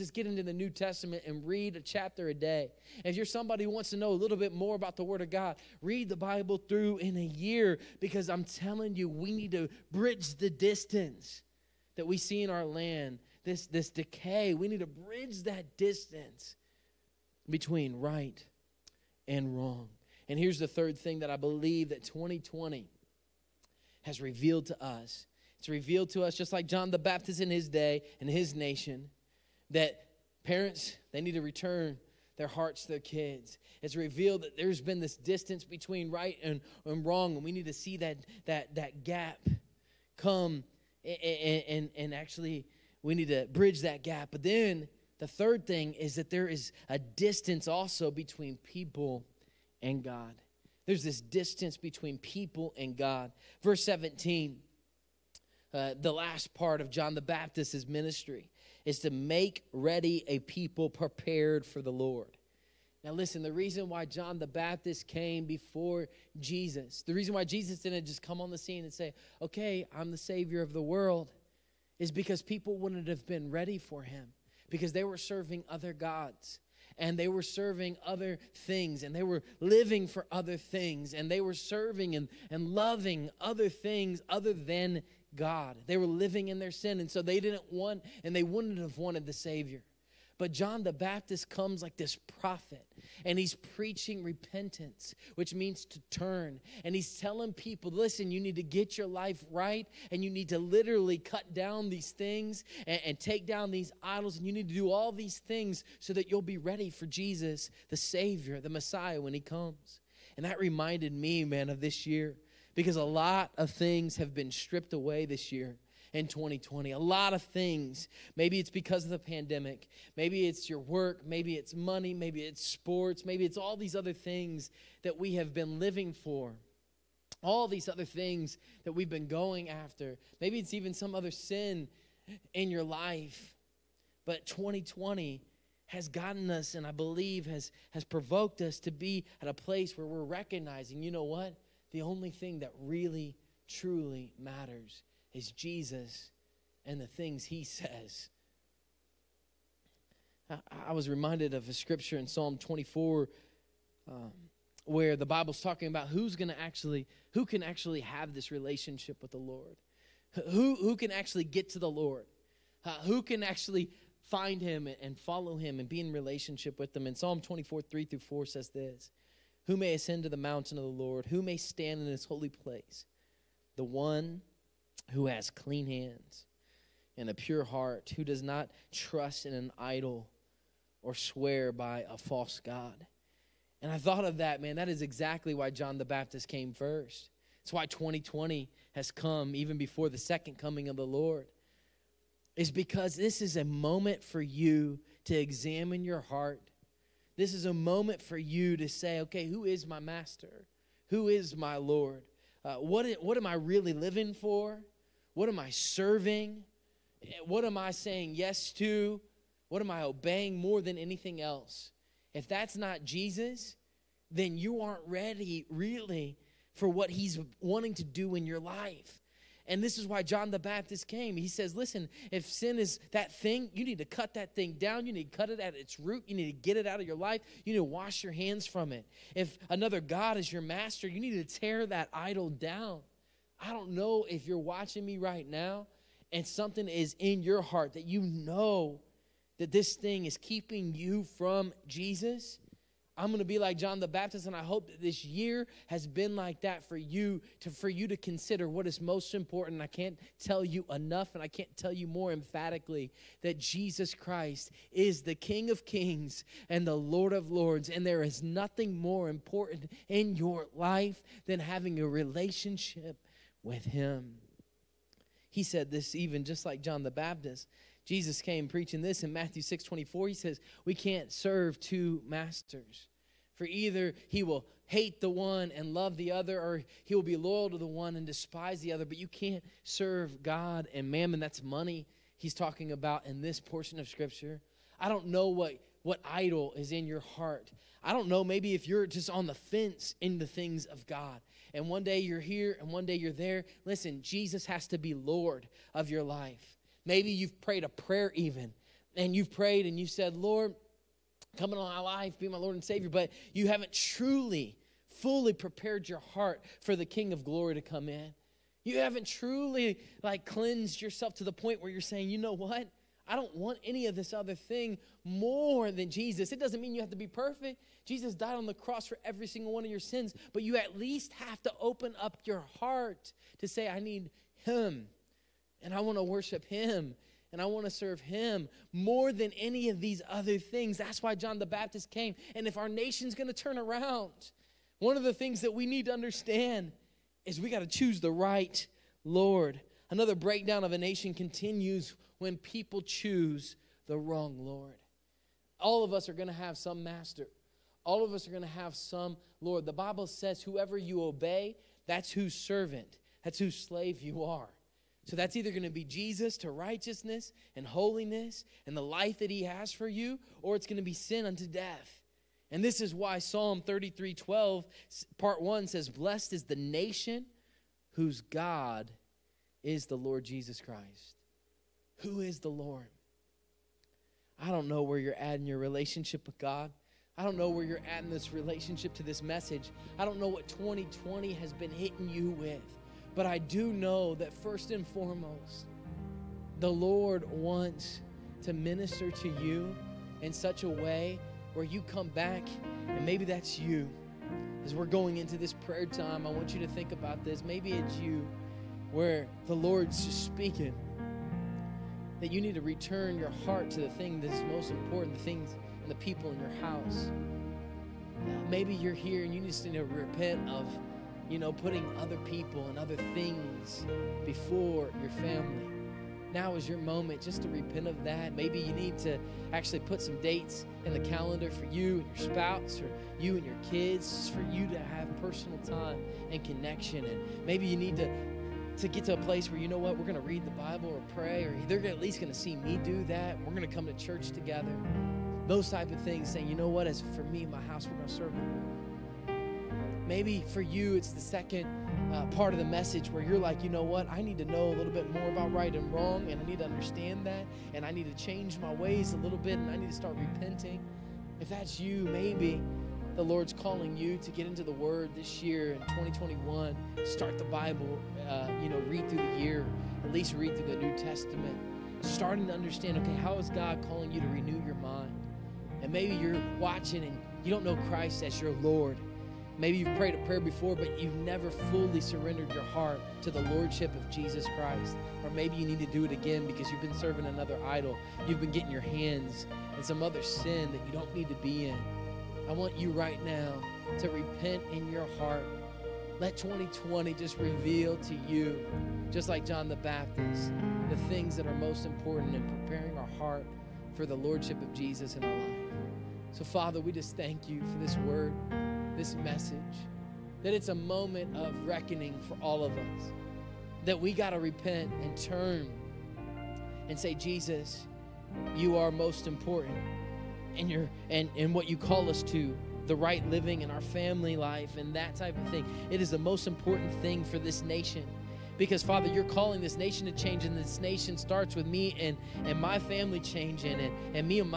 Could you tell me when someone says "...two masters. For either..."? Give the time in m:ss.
4:31.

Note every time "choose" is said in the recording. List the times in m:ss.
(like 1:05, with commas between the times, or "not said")
5:37, 5:43.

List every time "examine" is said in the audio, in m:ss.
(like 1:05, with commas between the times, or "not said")
3:15.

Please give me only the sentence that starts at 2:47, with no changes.
And Psalm 24, 3 through 4 says this Who may ascend to the mountain of the Lord?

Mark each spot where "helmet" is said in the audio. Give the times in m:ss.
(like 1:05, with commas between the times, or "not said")
not said.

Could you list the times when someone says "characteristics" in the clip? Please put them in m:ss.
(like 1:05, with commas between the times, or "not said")
not said.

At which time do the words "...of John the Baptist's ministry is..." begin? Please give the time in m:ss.
0:56.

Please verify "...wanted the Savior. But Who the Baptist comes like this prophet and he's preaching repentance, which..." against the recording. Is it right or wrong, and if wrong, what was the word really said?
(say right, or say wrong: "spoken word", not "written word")
wrong: "John", not "Who".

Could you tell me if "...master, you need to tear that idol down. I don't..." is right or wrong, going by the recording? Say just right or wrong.
right.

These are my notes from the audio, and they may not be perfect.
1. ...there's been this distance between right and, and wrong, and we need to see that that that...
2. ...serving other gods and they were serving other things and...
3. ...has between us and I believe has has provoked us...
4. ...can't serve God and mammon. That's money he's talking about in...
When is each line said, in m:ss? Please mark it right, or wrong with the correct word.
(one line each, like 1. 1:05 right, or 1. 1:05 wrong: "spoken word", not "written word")
1. 0:34 right
2. 1:15 right
3. 2:15 wrong: "gotten", not "between"
4. 4:39 right.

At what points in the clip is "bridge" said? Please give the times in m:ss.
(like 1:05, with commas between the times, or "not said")
0:09, 0:14, 0:43.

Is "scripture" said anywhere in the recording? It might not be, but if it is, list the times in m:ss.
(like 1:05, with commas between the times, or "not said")
2:31, 4:44.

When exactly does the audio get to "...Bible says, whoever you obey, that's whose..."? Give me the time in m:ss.
5:49.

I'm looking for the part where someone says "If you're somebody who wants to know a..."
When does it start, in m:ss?
0:03.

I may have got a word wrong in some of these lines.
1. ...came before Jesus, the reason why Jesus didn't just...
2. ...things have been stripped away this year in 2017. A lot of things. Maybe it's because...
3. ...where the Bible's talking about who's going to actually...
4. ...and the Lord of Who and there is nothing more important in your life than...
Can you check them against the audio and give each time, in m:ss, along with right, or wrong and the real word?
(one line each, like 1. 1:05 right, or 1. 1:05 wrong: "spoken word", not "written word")
1. 1:05 right
2. 1:53 wrong: "2020", not "2017"
3. 2:34 right
4. 4:16 wrong: "Lords", not "Who".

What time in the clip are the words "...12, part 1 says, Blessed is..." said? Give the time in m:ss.
6:04.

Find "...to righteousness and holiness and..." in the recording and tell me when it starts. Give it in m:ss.
5:56.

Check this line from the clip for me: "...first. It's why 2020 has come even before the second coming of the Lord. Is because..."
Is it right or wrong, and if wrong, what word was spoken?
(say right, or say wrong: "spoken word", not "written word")
right.